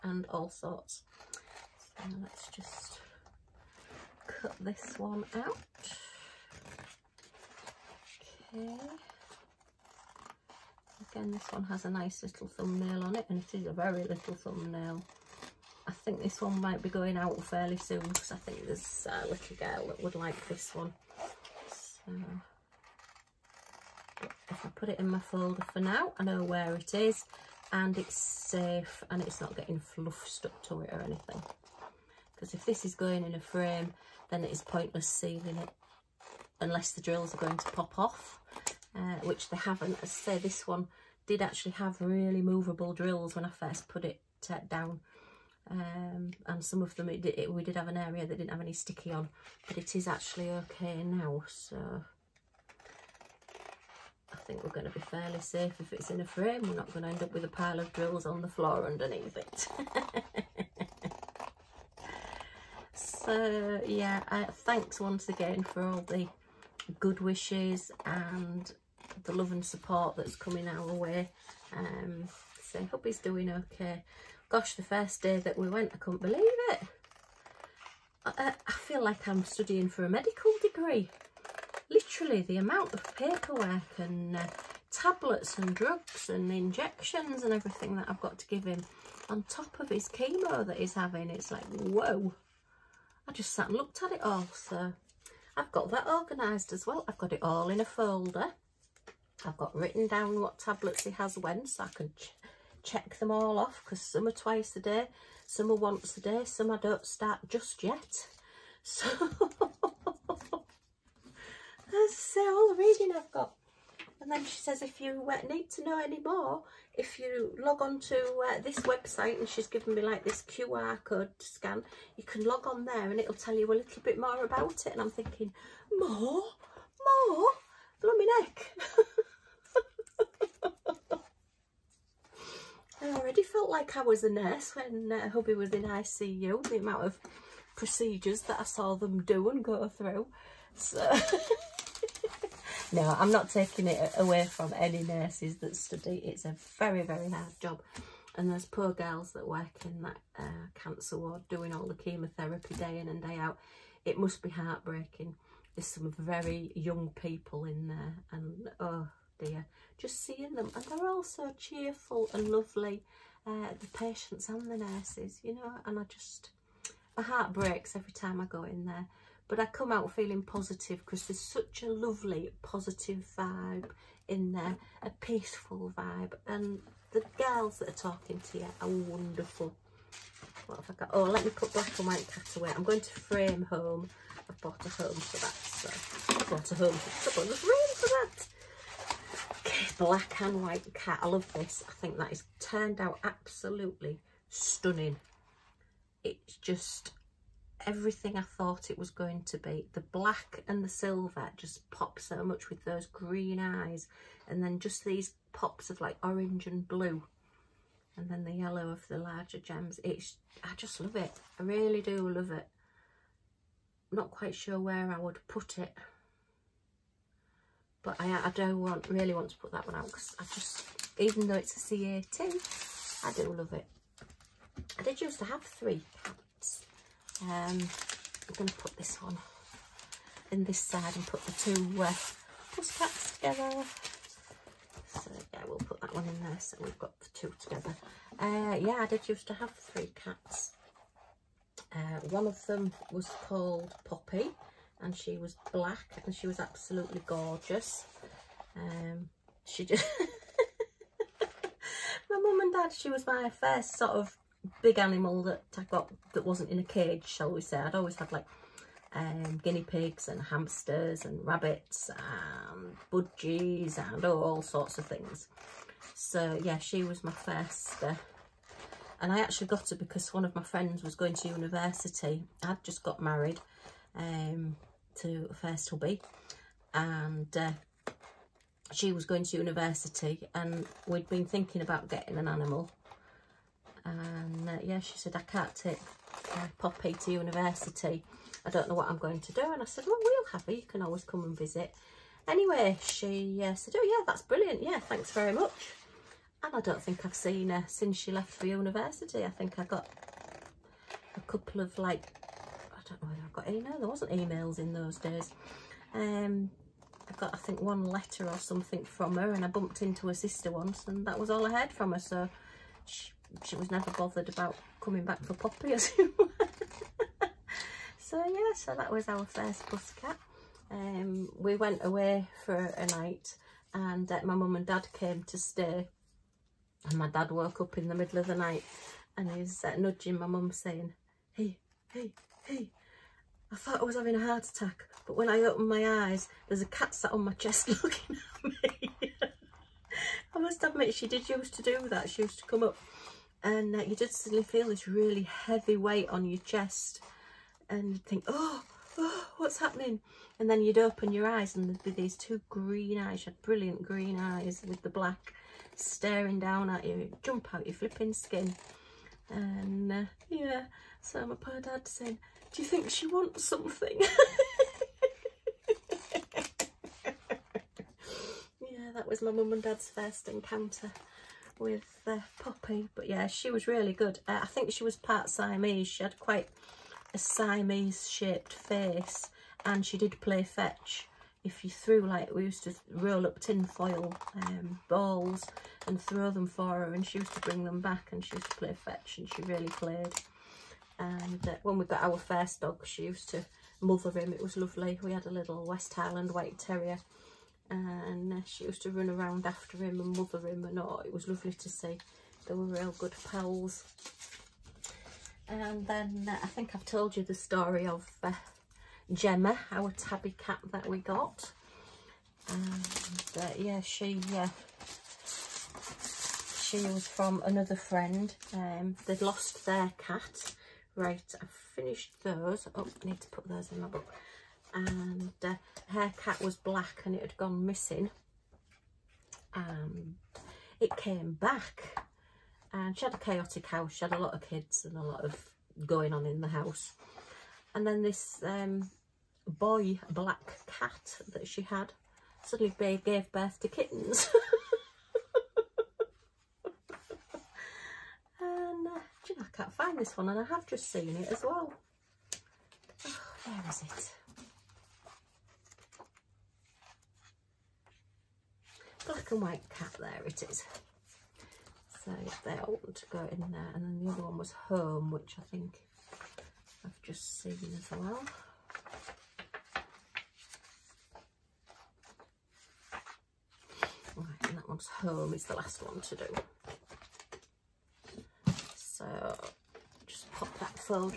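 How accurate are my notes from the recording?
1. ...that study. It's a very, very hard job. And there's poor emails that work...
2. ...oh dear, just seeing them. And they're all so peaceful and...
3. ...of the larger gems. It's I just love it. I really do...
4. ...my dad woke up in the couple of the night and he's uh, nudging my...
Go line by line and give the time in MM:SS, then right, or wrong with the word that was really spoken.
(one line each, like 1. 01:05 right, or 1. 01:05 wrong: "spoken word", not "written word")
1. 02:25 wrong: "girls", not "emails"
2. 02:38 wrong: "cheerful", not "peaceful"
3. 03:28 right
4. 05:27 wrong: "middle", not "couple".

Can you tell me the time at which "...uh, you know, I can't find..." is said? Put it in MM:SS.
07:29.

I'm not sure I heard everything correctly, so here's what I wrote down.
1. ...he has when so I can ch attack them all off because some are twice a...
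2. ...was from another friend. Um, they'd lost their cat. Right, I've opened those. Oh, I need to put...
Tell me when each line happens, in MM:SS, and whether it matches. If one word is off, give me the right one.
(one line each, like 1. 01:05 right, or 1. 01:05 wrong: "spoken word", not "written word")
1. 01:41 wrong: "check", not "attack"
2. 06:56 wrong: "finished", not "opened".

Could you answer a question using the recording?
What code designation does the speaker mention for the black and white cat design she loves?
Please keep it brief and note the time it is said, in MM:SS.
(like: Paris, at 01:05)
C18, at 03:41.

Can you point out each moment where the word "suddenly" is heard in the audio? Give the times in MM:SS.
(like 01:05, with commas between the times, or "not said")
05:44, 07:22.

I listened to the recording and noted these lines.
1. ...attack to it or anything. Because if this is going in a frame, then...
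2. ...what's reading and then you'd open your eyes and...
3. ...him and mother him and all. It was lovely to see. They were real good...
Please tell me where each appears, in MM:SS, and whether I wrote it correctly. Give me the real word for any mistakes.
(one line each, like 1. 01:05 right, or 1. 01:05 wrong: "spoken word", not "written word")
1. 00:30 wrong: "stuck", not "attack"
2. 05:49 wrong: "happening", not "reading"
3. 06:39 right.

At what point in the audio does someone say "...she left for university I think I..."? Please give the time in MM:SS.
04:58.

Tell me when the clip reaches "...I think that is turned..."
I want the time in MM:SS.
03:11.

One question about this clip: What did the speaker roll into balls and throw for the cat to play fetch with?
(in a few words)
Tin foil.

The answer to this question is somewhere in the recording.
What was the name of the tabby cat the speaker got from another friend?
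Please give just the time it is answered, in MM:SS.
06:49.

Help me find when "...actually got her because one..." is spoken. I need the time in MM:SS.
04:29.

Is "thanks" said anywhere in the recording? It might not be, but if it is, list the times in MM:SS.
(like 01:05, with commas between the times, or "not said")
01:04, 04:54.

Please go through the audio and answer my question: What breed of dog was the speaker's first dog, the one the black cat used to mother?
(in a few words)
West Highland White Terrier.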